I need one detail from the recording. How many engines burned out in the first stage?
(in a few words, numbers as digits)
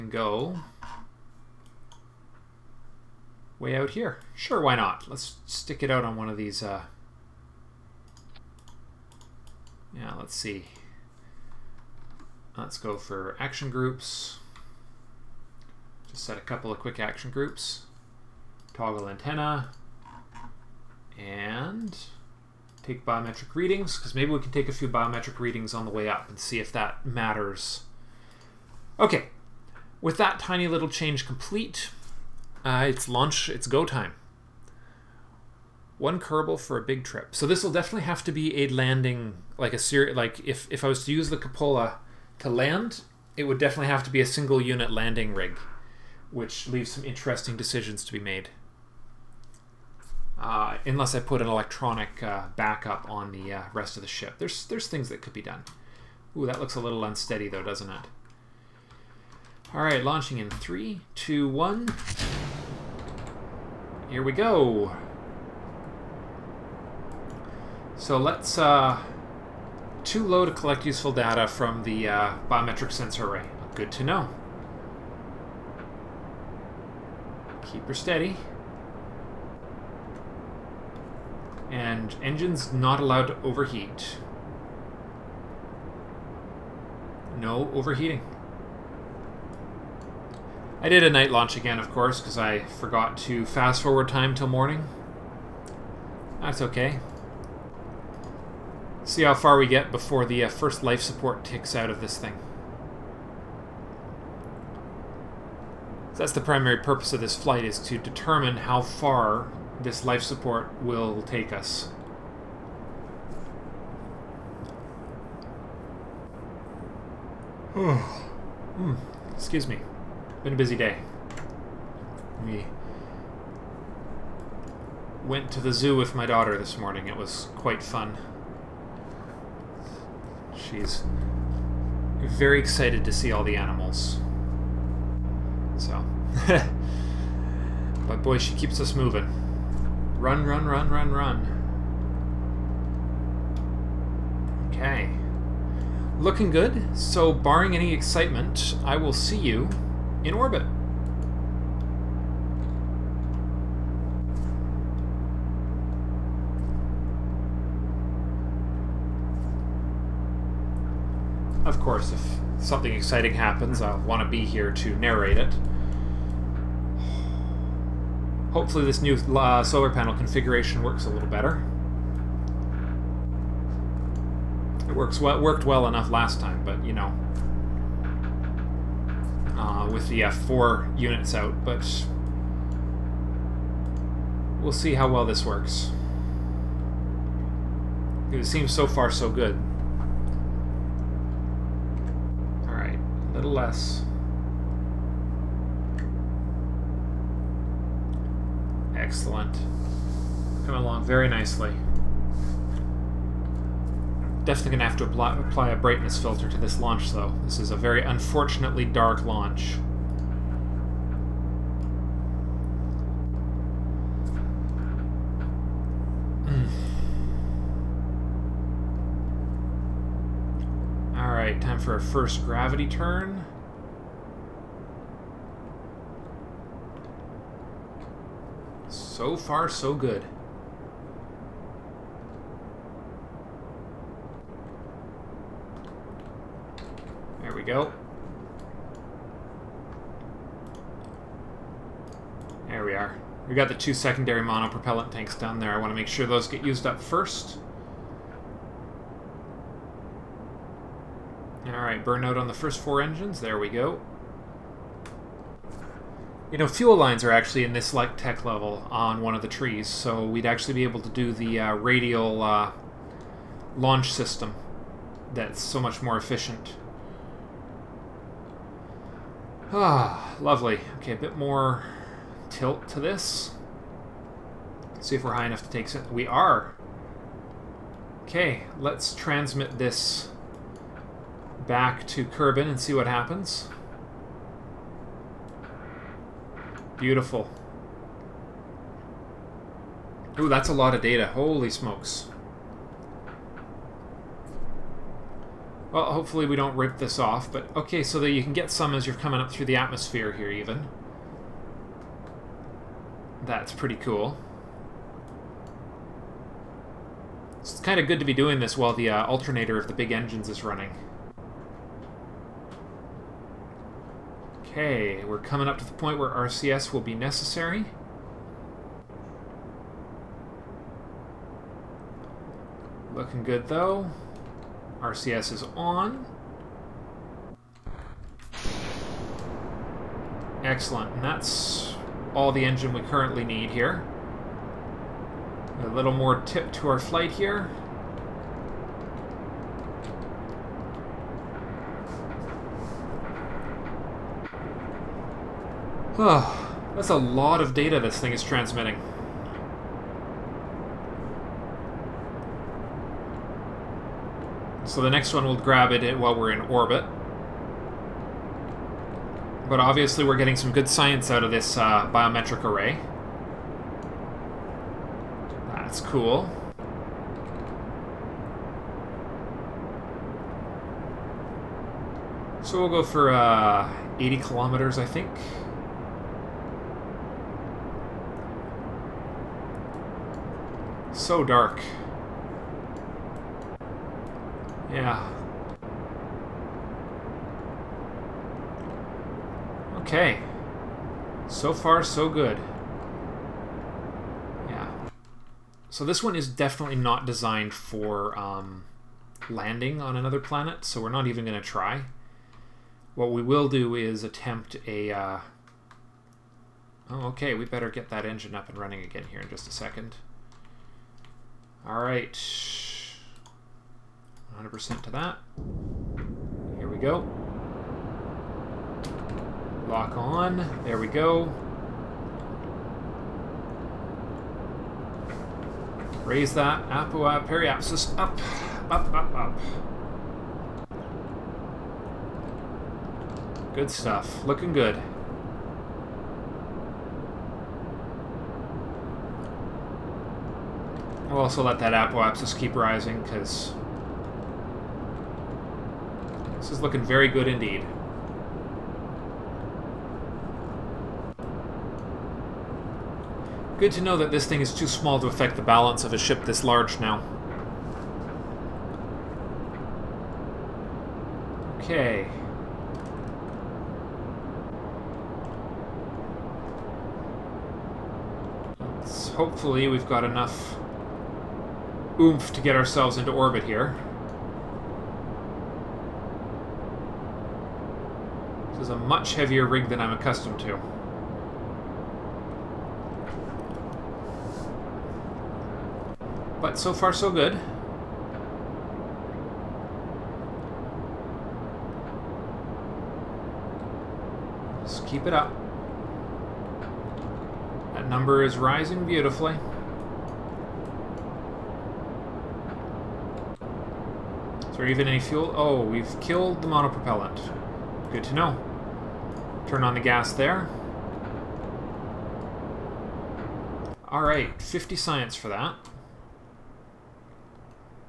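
4.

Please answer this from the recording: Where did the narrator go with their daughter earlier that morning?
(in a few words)
The zoo.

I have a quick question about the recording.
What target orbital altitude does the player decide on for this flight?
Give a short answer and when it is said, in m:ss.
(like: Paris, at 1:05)
80 kilometers, at 6:14.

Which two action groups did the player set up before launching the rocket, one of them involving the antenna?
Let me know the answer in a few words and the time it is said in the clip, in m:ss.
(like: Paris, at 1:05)
Toggle antenna and take biometric readings, at 0:18.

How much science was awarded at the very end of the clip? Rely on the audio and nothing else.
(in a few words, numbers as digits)
50.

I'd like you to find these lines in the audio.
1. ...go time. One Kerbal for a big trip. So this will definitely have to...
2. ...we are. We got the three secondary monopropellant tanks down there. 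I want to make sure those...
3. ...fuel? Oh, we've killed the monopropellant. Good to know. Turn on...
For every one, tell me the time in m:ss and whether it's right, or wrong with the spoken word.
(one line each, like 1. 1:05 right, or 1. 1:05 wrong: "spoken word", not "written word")
1. 0:33 right
2. 4:02 wrong: "two", not "three"
3. 8:25 right.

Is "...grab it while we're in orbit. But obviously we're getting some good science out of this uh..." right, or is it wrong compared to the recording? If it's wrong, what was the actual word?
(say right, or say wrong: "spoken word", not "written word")
right.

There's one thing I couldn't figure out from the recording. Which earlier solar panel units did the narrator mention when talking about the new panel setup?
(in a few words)
F4 units.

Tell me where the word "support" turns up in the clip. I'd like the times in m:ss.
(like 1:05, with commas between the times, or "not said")
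1:41, 1:50.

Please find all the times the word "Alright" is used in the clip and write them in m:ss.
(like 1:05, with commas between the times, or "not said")
4:11, 8:34.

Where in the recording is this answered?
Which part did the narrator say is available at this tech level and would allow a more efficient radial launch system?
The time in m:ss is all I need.
4:16.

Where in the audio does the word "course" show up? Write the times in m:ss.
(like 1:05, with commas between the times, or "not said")
1:31, 2:41.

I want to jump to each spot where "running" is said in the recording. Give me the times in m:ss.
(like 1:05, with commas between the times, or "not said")
5:10, 6:48.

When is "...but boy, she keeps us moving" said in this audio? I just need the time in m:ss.
2:18.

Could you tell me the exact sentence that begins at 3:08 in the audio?
It seems so far so good.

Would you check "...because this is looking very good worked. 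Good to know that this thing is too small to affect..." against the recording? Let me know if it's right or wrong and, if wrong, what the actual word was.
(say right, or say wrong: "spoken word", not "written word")
wrong: "indeed", not "worked".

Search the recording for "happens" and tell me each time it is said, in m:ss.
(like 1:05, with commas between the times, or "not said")
2:43, 4:43.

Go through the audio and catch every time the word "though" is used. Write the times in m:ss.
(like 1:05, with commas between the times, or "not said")
0:57, 3:27, 5:23.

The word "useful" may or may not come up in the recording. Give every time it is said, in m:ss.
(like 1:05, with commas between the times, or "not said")
1:10.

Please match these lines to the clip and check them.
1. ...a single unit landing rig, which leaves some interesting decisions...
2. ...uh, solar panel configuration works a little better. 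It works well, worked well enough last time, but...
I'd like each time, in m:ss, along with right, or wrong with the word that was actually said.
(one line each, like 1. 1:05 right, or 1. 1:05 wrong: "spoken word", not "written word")
1. 0:44 right
2. 2:49 right.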